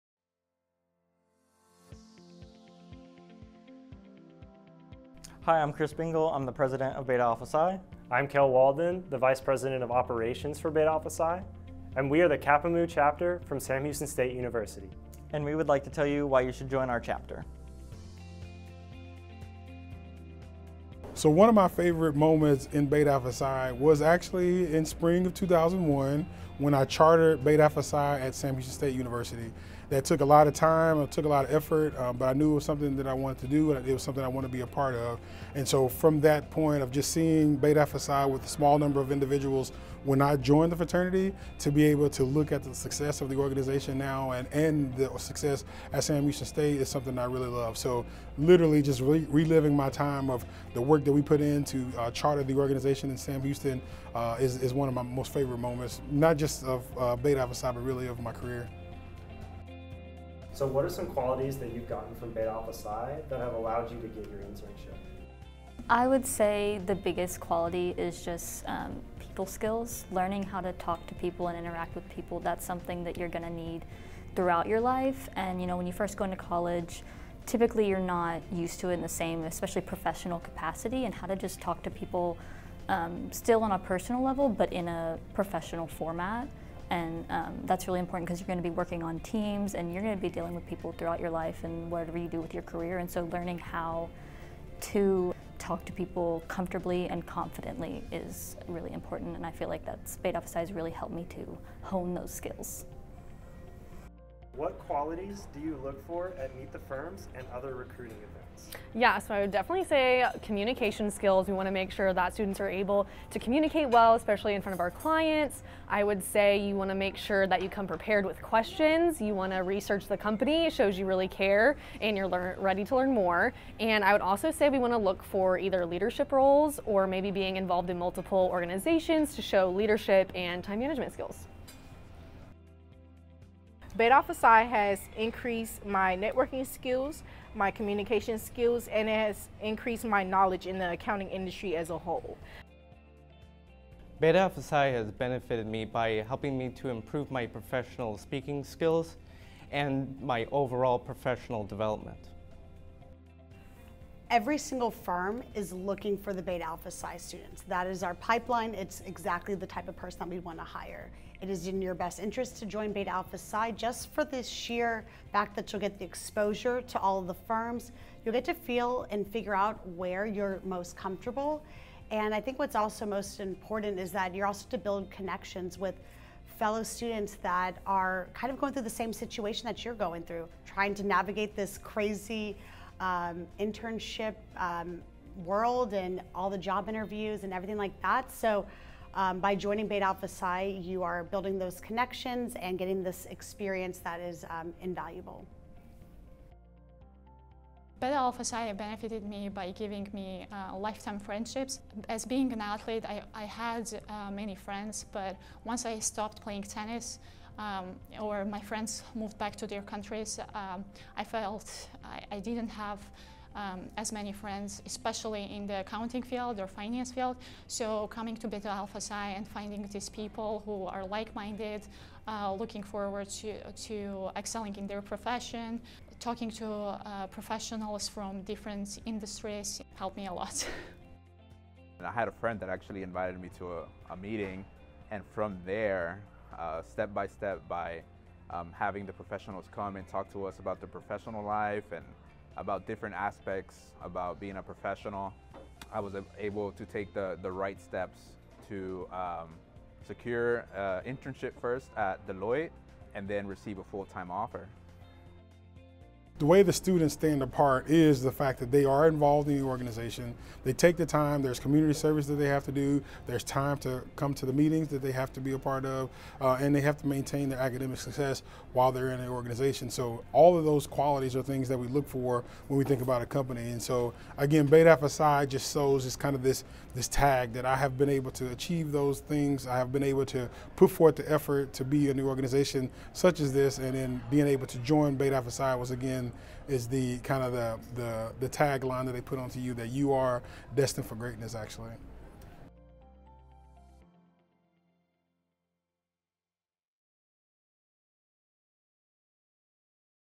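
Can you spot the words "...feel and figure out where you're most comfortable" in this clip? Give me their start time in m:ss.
2:48.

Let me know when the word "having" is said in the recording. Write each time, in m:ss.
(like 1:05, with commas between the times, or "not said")
3:58.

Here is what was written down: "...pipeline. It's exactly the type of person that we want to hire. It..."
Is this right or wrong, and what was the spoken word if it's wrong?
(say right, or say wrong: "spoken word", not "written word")
right.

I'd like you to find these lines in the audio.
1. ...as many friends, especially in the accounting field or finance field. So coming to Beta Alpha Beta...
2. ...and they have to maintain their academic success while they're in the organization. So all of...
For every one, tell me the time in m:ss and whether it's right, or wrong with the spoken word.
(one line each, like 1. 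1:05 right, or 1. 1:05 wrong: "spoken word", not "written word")
1. 3:33 wrong: "Psi", not "Beta"
2. 4:26 right.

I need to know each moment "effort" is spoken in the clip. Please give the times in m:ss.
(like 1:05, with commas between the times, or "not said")
0:31, 4:41.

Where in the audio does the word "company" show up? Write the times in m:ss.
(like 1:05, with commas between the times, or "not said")
2:00, 4:33.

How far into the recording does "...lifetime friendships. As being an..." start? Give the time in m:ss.
3:20.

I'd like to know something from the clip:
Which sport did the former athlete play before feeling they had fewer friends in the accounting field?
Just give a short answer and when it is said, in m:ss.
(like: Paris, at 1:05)
tennis, at 3:26.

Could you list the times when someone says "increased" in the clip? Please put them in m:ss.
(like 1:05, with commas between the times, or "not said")
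2:15, 2:19.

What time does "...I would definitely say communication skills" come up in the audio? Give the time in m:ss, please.
1:49.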